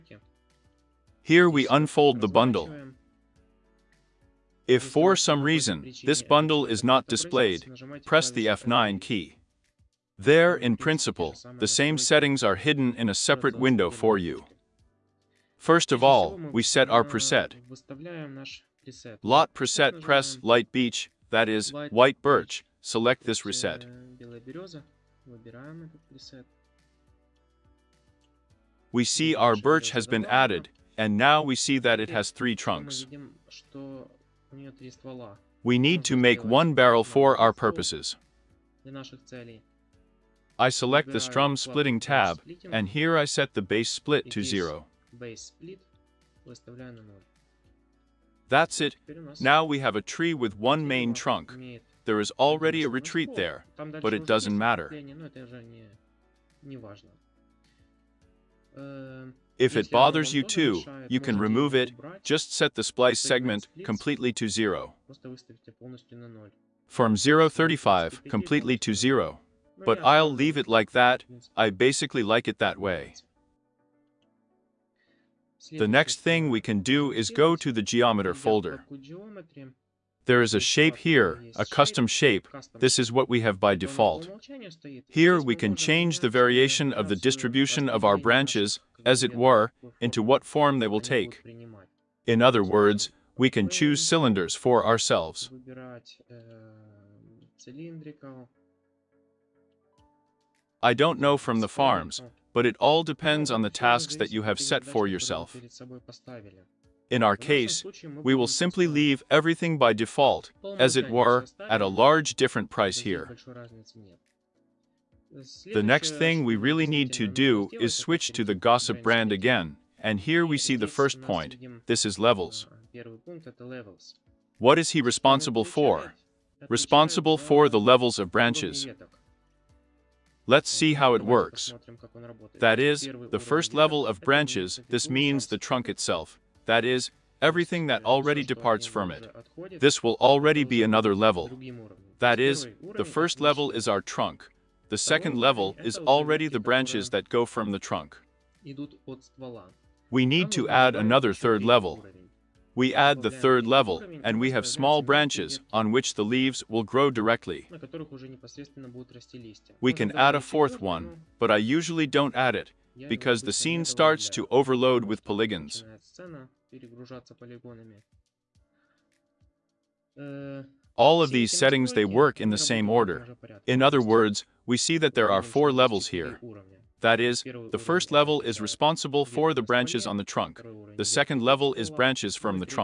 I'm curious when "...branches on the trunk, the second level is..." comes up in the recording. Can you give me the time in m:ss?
2:59.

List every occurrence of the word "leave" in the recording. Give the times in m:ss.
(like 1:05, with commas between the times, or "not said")
1:10, 1:48, 2:36.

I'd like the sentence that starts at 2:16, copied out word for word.
That is, э, everything that already departs from it.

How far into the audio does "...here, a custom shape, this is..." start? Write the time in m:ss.
1:20.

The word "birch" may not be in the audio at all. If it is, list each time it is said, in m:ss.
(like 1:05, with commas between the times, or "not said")
0:22, 0:29.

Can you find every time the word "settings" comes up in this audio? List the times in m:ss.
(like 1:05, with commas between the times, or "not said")
0:11, 2:51.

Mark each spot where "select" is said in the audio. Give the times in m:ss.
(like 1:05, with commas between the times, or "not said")
0:22, 0:40.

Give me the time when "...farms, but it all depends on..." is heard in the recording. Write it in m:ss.
1:41.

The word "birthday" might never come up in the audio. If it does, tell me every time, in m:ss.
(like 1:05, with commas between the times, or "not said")
not said.